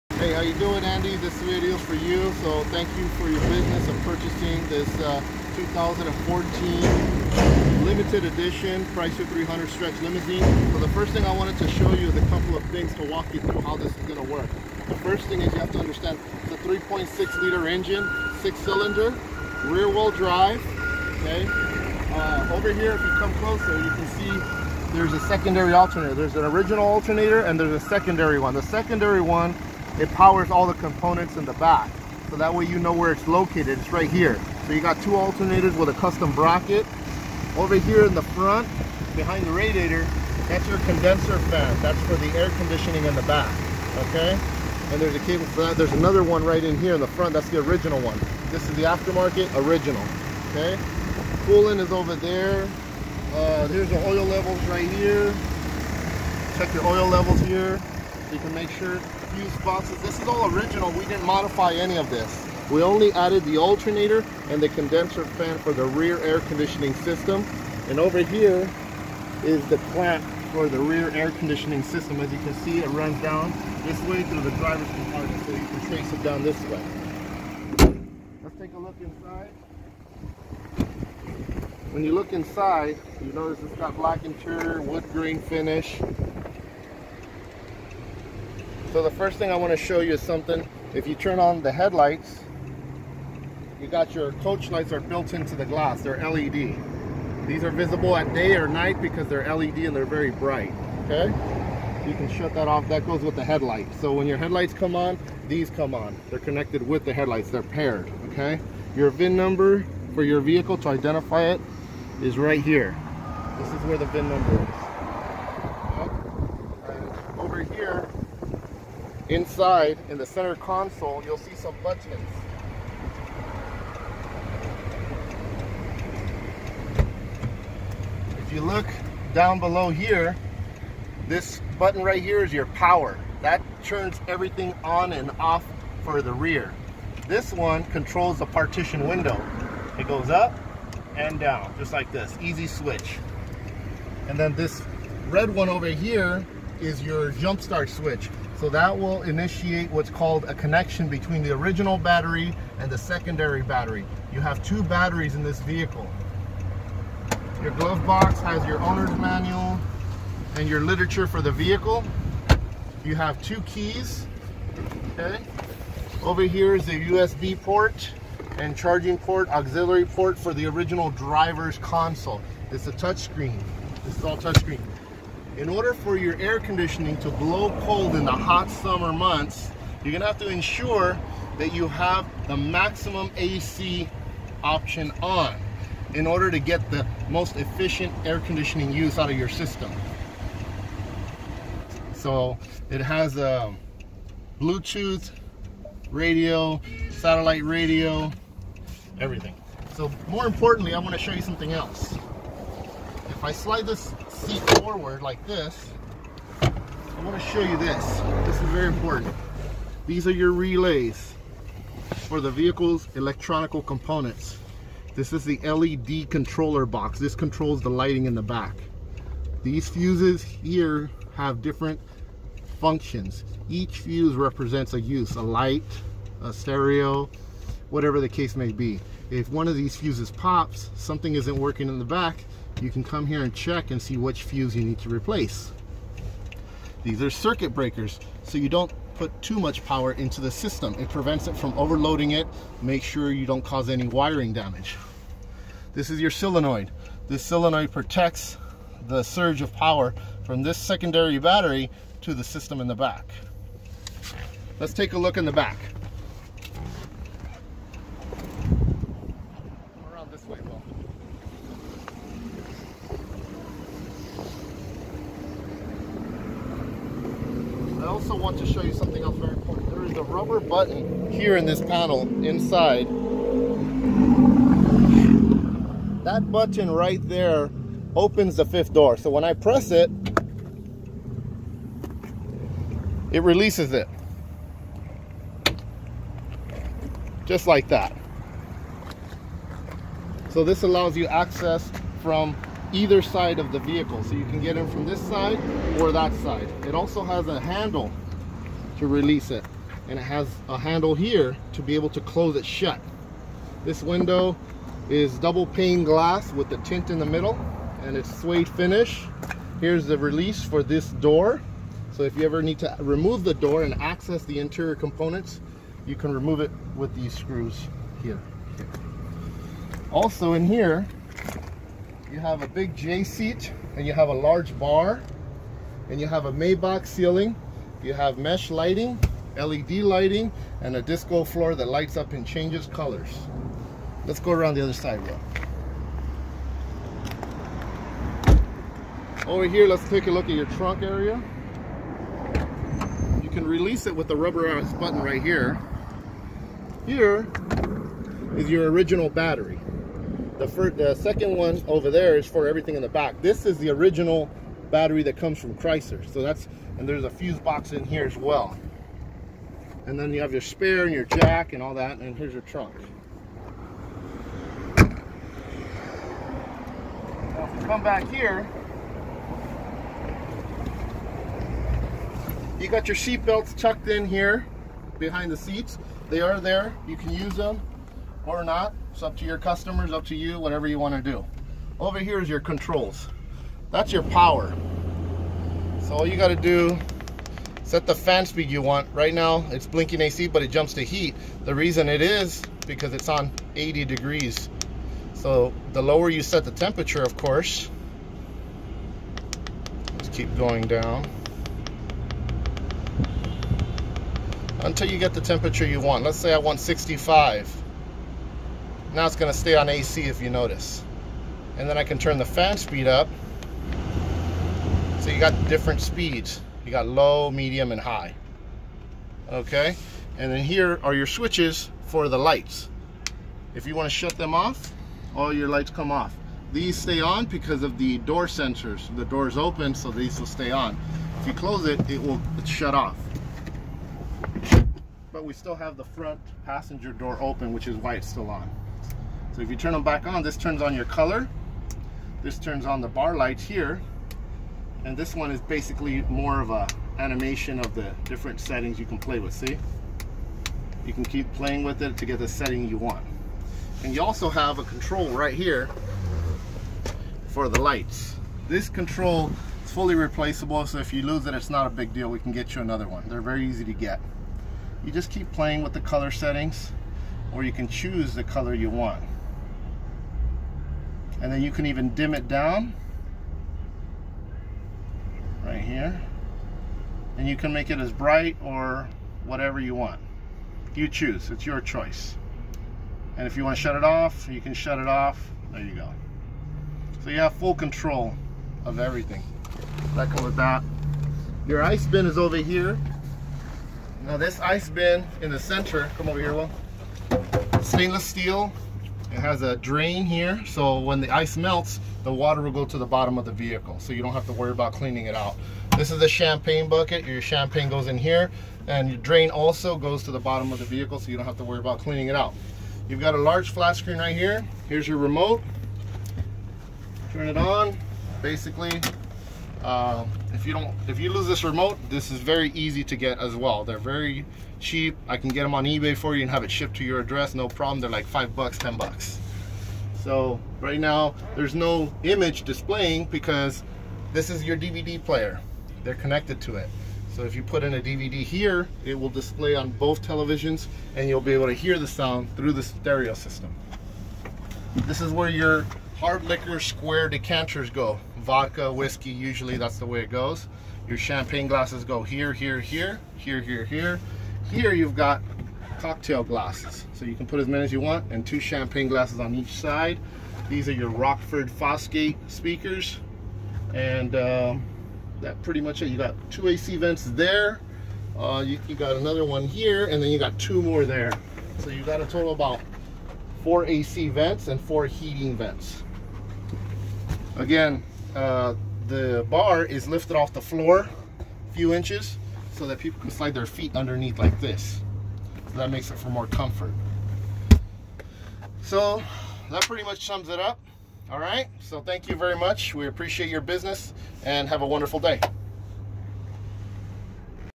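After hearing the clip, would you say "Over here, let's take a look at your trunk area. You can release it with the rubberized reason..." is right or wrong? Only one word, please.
wrong.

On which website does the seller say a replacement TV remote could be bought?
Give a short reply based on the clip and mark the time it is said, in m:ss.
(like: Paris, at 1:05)
eBay, at 8:45.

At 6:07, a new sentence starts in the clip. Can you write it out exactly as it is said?
Now if you come back here, you got your seat belts tucked in here behind the seats.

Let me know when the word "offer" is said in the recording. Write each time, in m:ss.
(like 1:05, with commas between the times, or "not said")
not said.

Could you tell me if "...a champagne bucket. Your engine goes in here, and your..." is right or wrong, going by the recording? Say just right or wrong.
wrong.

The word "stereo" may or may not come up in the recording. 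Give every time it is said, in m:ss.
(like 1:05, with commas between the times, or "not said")
3:46, 9:02.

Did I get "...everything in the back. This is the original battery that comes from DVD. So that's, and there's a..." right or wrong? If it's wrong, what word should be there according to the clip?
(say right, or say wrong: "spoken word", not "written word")
wrong: "Chrysler", not "DVD".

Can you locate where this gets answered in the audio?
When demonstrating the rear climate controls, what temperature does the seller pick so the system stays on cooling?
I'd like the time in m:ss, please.
6:46.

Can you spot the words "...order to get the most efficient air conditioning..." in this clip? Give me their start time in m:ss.
3:06.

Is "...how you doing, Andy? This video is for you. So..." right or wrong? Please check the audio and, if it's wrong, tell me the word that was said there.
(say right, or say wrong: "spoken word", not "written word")
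right.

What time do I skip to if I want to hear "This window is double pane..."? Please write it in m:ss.
5:03.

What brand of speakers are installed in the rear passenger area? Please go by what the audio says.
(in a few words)
Rockford Fosgate.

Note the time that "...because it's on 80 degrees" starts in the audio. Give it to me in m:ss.
6:32.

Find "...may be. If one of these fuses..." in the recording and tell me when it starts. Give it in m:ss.
3:48.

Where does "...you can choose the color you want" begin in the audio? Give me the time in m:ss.
7:47.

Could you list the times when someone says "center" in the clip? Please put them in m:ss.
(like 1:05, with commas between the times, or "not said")
2:00, 8:15.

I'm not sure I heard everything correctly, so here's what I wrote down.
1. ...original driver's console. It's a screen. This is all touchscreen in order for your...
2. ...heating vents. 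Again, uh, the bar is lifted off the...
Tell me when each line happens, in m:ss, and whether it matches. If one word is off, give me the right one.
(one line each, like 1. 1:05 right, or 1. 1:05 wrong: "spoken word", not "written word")
1. 2:50 wrong: "touchscreen", not "screen"
2. 9:35 right.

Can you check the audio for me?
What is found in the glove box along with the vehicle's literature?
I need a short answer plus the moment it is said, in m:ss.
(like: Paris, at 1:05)
owner's manual, at 2:38.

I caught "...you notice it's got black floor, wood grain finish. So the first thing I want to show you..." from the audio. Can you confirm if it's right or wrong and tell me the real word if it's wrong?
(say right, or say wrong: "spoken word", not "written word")
wrong: "interior", not "floor".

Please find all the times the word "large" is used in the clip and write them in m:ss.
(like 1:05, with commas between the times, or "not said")
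5:24, 8:33.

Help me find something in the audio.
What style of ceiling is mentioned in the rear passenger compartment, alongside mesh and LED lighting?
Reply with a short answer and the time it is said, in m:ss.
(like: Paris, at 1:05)
Maybach ceiling, at 5:26.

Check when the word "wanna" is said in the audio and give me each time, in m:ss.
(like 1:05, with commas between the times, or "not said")
3:20, 6:20.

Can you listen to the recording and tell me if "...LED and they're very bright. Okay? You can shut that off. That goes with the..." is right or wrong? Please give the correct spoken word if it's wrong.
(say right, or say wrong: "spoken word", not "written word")
right.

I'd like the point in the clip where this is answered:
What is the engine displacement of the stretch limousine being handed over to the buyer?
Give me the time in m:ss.
0:16.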